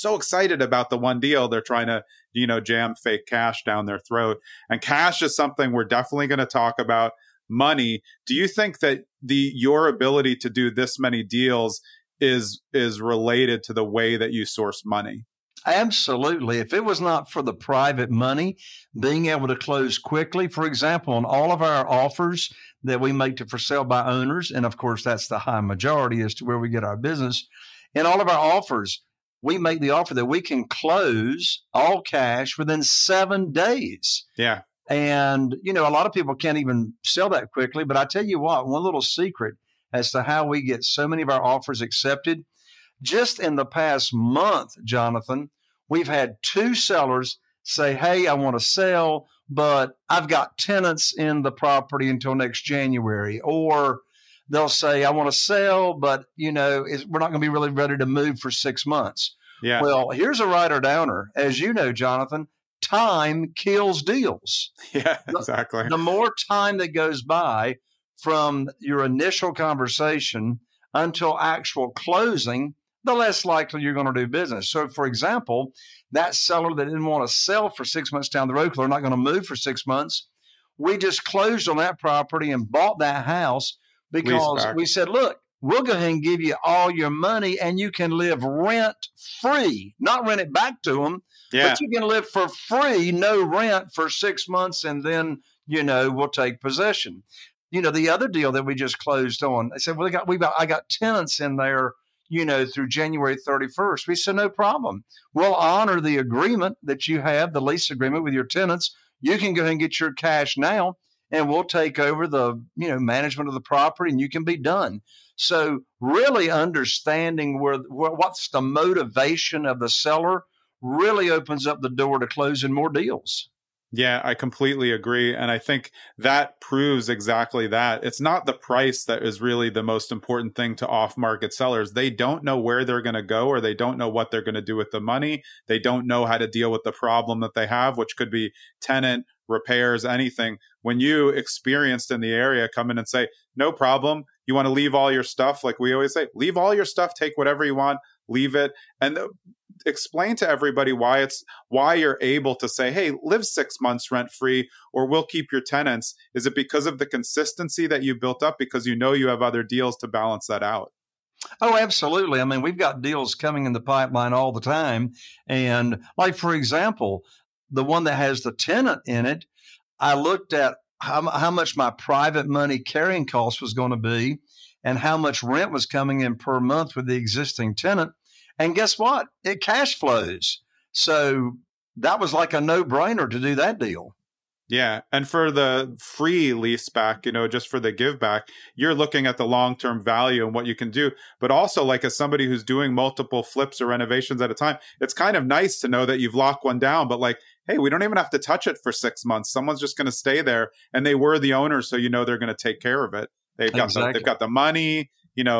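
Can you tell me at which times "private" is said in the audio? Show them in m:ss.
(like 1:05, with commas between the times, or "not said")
0:17, 2:51.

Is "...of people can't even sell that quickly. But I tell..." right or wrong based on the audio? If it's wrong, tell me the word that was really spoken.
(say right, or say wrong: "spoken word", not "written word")
right.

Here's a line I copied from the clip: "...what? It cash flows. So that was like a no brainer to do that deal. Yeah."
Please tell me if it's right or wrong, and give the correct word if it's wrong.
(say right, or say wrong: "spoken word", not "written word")
right.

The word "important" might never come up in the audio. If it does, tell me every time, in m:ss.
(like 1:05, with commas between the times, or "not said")
2:10.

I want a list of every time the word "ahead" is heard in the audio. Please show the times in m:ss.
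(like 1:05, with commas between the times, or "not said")
1:25, 1:49.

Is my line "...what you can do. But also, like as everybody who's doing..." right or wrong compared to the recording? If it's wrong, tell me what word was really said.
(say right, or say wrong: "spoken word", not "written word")
wrong: "somebody", not "everybody".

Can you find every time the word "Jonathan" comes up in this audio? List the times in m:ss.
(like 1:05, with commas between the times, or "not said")
0:44, 1:01.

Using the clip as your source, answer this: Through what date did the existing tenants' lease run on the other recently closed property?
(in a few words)
January 31st.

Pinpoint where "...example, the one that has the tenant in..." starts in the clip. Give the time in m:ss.
2:46.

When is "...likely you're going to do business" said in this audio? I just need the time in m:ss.
1:13.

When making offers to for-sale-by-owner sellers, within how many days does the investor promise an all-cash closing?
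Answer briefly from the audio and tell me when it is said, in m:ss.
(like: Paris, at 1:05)
7 days, at 0:32.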